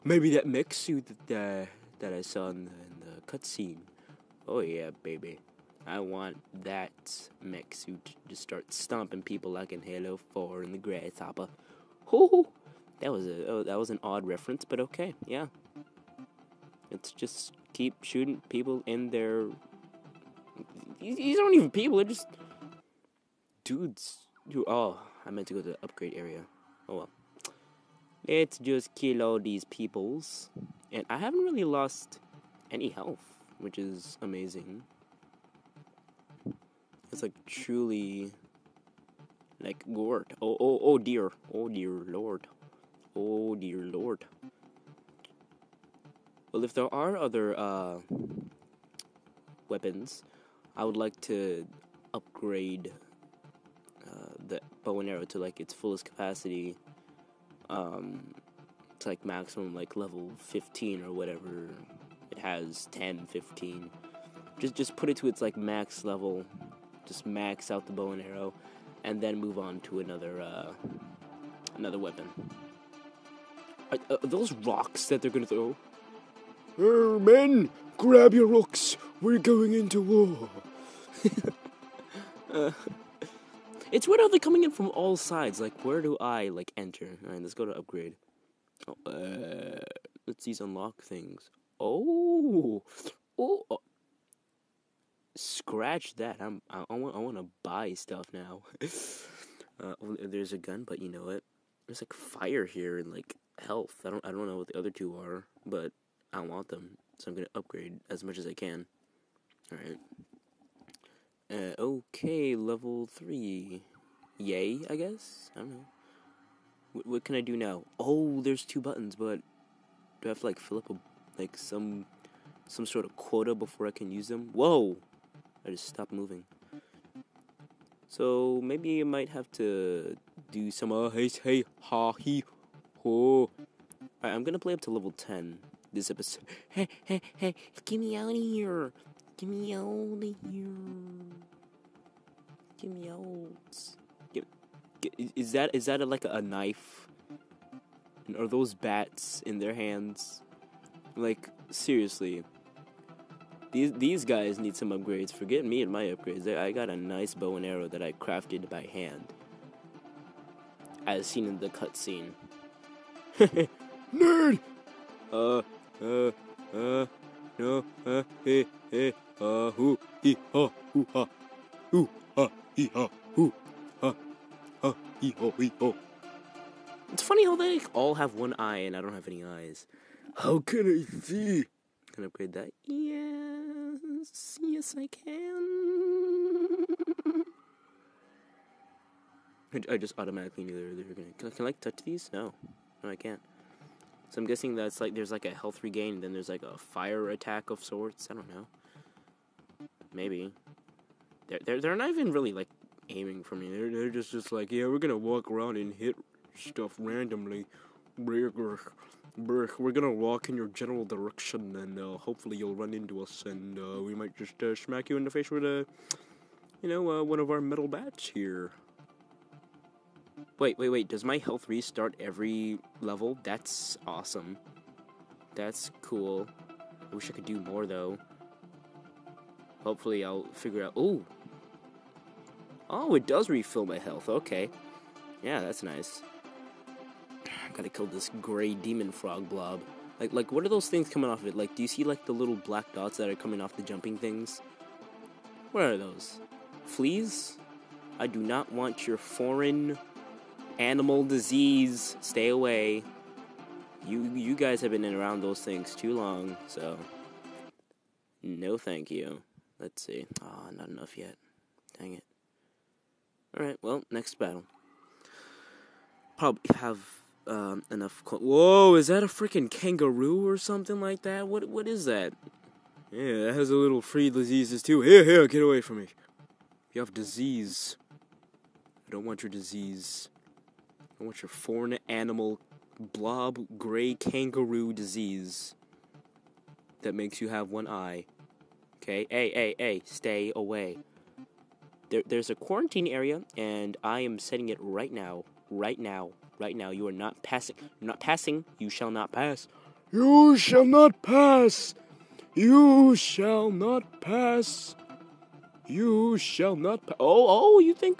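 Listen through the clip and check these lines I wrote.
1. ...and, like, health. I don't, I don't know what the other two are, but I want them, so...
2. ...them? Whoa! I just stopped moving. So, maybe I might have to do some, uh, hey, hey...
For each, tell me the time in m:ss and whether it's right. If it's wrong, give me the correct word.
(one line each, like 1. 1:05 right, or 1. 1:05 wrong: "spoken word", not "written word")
1. 1:42 right
2. 2:04 right.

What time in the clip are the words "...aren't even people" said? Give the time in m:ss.
0:21.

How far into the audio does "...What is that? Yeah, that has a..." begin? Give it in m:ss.
4:31.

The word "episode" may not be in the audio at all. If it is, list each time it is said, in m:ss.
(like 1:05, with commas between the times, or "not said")
2:16.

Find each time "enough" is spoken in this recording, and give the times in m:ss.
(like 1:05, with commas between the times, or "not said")
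4:20, 4:27.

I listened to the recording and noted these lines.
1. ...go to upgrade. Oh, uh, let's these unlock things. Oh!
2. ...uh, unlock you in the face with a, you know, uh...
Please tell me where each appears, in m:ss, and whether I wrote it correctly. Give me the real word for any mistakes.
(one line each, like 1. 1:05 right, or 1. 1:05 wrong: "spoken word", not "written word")
1. 1:27 right
2. 3:34 wrong: "smack", not "unlock".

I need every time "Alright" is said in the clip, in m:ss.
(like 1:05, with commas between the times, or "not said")
1:27, 1:49, 2:13, 4:23.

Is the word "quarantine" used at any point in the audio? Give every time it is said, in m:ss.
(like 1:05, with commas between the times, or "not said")
4:52.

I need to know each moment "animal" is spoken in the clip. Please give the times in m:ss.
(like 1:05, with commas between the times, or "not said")
4:10, 4:42.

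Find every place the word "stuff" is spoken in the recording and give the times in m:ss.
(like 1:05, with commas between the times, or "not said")
1:37, 3:26.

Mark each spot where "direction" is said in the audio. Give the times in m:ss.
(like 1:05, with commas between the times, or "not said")
3:31.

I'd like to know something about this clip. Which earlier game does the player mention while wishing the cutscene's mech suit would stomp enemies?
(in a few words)
Halo 4.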